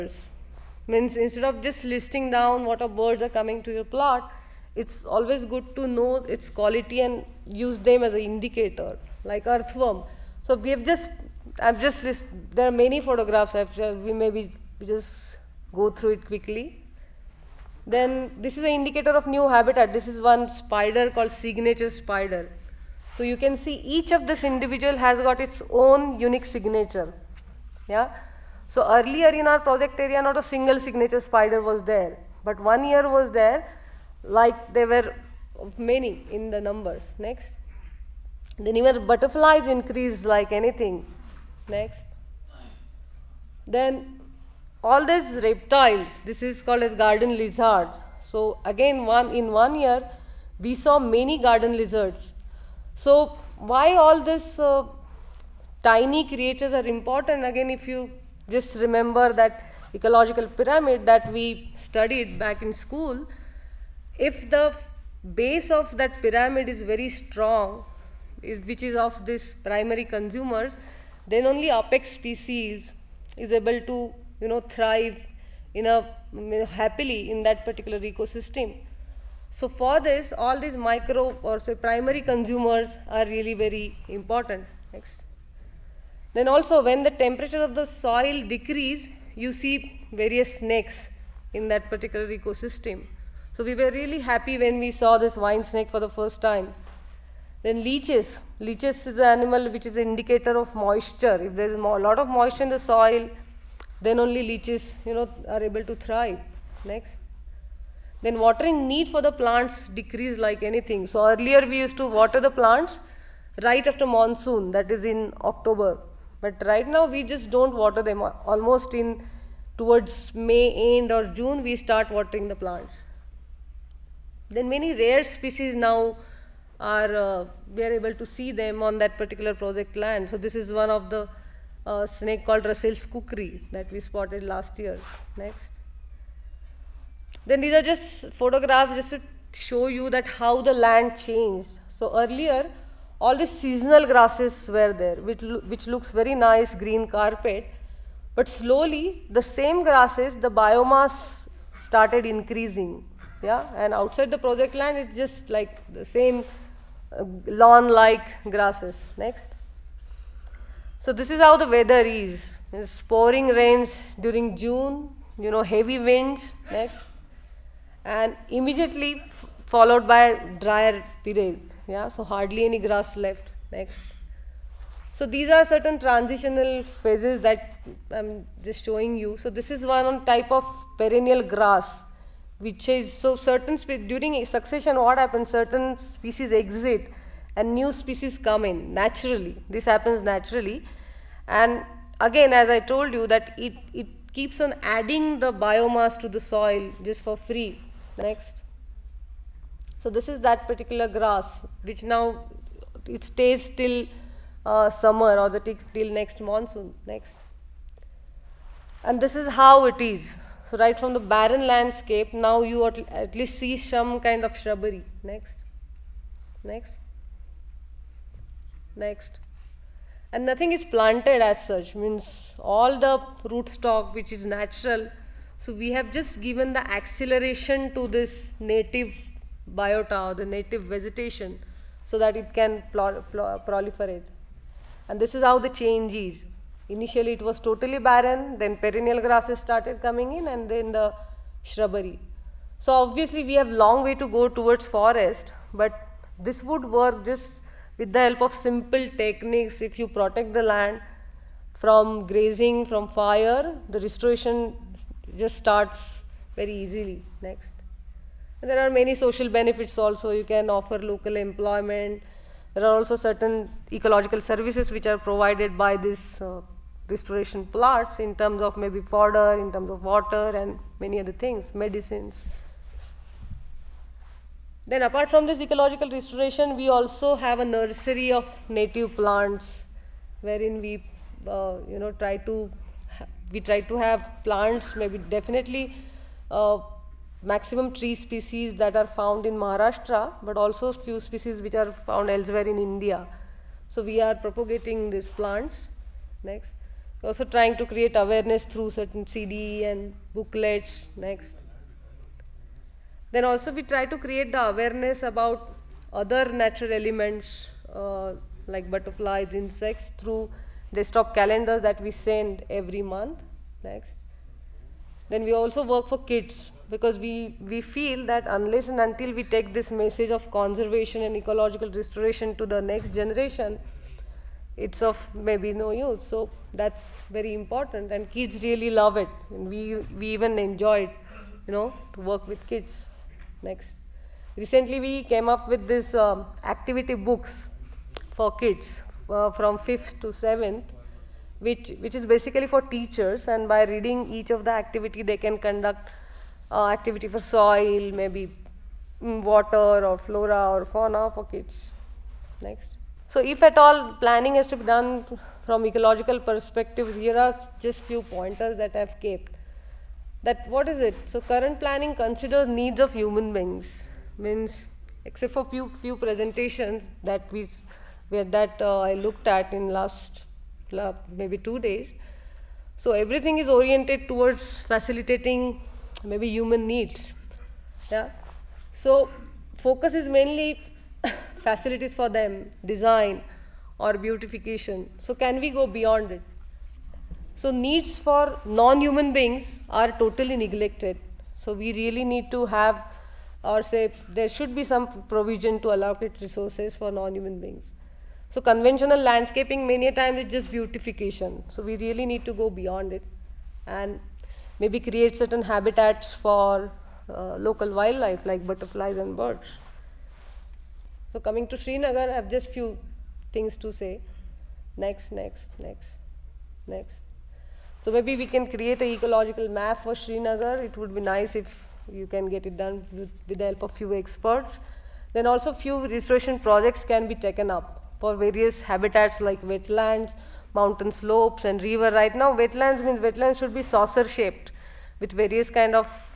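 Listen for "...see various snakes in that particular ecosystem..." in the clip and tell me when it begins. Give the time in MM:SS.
01:29.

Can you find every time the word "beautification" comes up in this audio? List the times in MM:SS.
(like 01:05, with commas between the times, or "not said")
06:24, 06:40.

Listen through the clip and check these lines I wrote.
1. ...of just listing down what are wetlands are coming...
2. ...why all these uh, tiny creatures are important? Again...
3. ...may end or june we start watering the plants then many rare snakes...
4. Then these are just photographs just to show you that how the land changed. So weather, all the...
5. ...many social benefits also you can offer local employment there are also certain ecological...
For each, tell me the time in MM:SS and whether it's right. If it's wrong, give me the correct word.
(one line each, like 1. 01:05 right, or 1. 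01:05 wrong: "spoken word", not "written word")
1. 00:01 wrong: "birds", not "wetlands"
2. 00:53 right
3. 02:00 wrong: "species", not "snakes"
4. 02:17 wrong: "earlier", not "weather"
5. 04:18 right.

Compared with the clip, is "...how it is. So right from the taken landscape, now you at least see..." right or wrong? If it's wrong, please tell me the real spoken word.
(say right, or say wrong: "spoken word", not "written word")
wrong: "barren", not "taken".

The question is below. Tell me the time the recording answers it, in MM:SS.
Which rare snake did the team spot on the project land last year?
02:12.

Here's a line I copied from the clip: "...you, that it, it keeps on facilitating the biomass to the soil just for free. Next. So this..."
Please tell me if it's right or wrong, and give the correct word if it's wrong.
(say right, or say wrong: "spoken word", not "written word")
wrong: "adding", not "facilitating".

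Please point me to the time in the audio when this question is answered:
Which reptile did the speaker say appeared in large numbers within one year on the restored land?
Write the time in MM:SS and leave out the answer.
00:46.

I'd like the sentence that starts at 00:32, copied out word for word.
But one year was there, like there were many in the numbers.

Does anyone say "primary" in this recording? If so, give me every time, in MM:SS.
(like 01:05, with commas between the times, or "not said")
01:09, 01:21.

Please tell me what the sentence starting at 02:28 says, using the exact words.
But slowly, the same grasses, the biomass started increasing.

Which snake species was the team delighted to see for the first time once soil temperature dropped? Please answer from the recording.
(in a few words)
vine snake.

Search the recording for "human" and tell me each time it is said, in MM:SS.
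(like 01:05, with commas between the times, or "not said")
06:03, 06:16, 06:28, 06:37.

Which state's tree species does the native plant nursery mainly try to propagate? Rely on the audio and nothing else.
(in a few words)
Maharashtra.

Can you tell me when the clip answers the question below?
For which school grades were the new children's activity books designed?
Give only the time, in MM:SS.
05:39.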